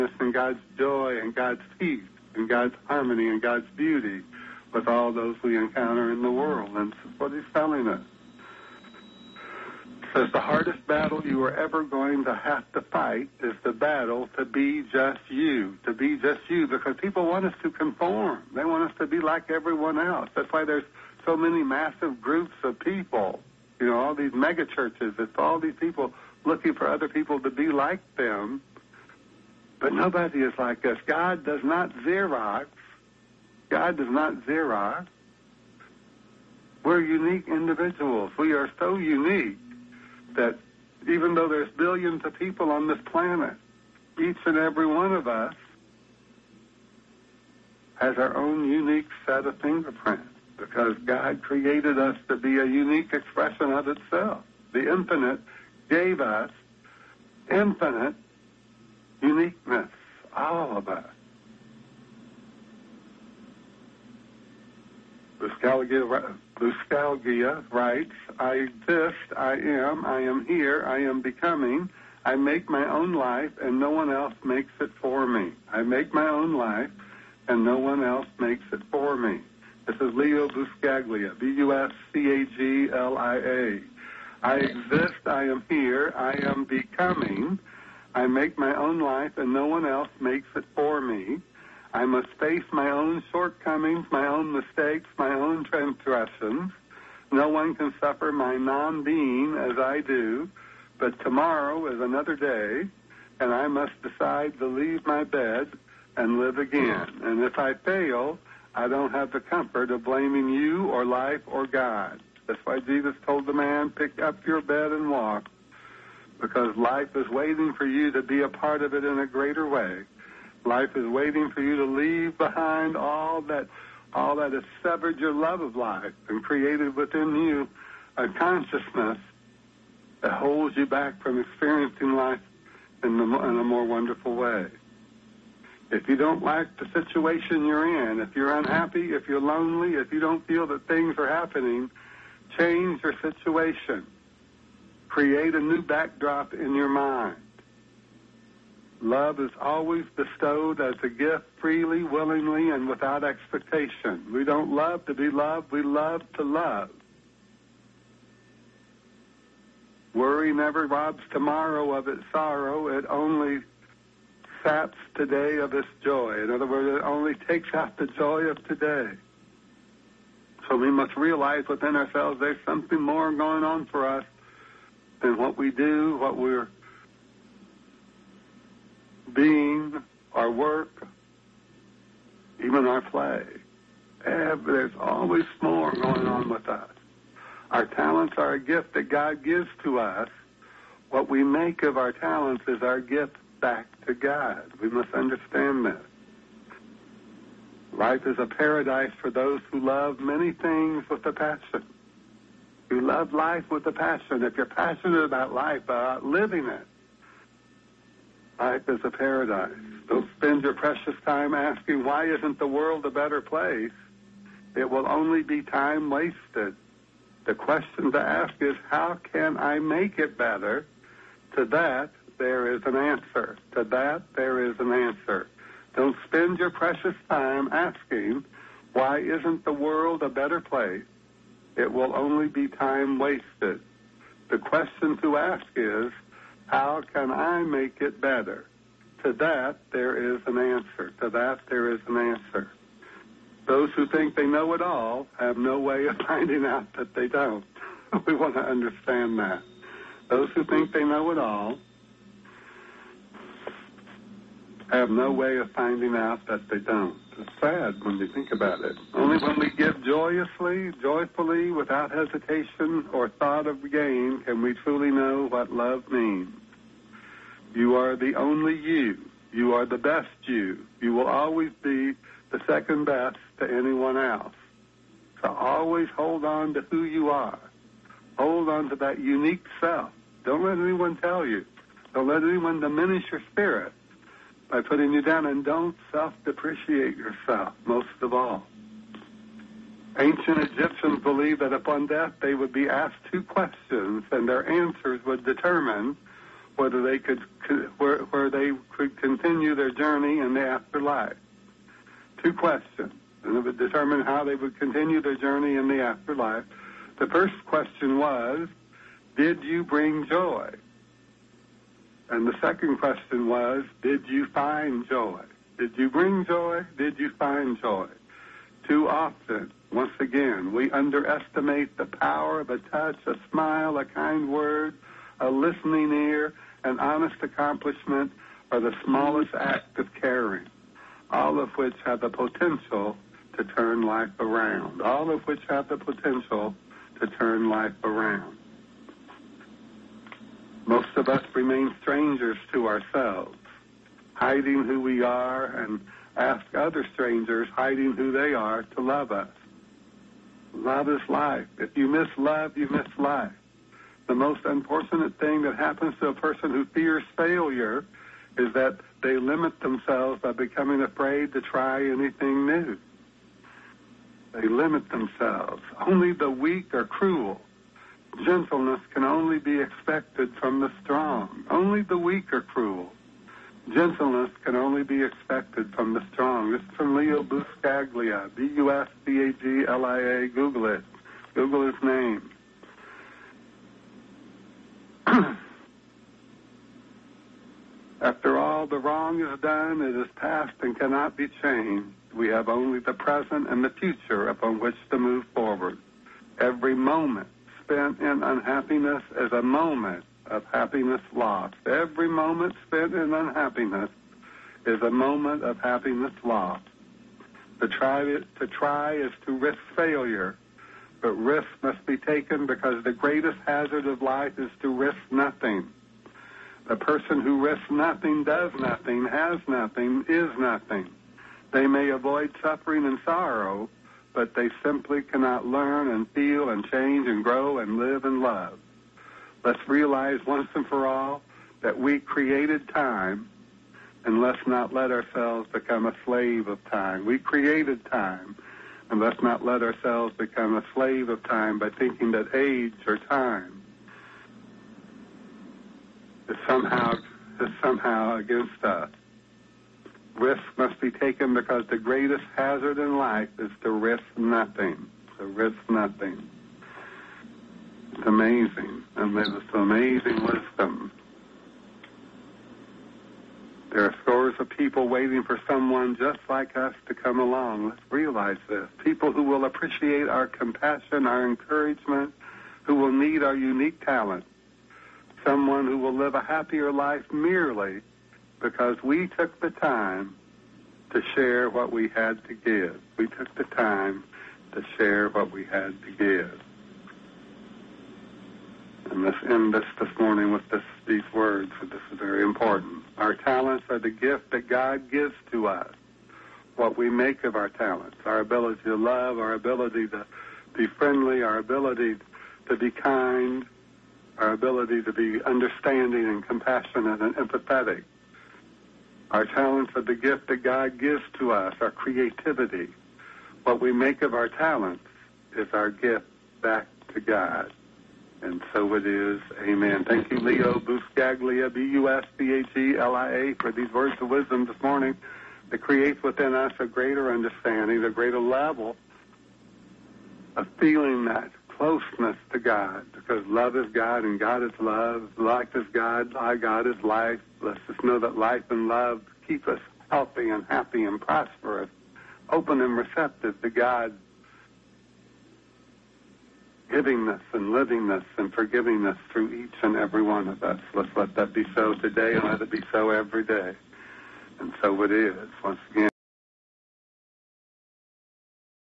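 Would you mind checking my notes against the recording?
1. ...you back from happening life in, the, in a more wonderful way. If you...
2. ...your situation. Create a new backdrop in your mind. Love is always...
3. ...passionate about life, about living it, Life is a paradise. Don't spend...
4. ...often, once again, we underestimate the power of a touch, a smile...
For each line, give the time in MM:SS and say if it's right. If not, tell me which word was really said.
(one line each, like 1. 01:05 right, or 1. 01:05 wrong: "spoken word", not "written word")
1. 02:10 wrong: "experiencing", not "happening"
2. 02:23 right
3. 03:24 right
4. 05:19 right.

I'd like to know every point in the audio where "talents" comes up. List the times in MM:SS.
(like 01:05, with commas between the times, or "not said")
03:07, 03:12, 07:54, 08:13, 08:17, 08:29, 08:34.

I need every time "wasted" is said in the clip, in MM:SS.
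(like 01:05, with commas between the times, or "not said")
03:36, 03:53.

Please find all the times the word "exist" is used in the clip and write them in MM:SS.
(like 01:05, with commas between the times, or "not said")
01:08, 01:24.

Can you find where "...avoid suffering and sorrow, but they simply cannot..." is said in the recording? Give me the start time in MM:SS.
07:02.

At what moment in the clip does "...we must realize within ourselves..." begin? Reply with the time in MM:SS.
02:50.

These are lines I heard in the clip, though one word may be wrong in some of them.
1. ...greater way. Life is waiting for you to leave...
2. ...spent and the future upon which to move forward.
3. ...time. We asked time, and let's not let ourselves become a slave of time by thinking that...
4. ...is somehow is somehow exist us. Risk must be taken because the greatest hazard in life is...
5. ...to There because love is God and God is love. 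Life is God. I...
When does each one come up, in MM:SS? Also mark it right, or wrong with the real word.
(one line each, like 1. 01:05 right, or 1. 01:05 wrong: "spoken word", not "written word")
1. 01:59 right
2. 06:33 wrong: "present", not "spent"
3. 07:16 wrong: "created", not "asked"
4. 07:26 wrong: "against", not "exist"
5. 08:52 wrong: "God", not "There".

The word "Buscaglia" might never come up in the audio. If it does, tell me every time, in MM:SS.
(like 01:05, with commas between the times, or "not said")
01:05, 01:20, 06:17, 08:40.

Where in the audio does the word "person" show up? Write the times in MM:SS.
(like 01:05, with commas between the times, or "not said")
05:56, 06:56.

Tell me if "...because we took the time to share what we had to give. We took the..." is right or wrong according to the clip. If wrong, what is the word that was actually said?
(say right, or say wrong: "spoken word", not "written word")
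right.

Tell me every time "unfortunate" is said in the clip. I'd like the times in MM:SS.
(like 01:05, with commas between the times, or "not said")
05:54.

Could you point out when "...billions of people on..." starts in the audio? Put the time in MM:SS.
00:41.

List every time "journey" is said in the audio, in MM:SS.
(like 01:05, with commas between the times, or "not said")
04:59, 05:05.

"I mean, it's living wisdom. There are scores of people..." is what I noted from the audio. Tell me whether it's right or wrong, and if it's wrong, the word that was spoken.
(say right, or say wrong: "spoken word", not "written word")
wrong: "amazing", not "living".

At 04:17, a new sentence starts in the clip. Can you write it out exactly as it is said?
It's sad when you think about it.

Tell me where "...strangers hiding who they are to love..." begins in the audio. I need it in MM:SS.
05:47.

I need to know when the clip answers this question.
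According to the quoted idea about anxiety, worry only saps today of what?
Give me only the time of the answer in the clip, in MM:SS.
02:42.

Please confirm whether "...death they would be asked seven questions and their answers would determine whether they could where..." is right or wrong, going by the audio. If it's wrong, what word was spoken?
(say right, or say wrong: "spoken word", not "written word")
wrong: "two", not "seven".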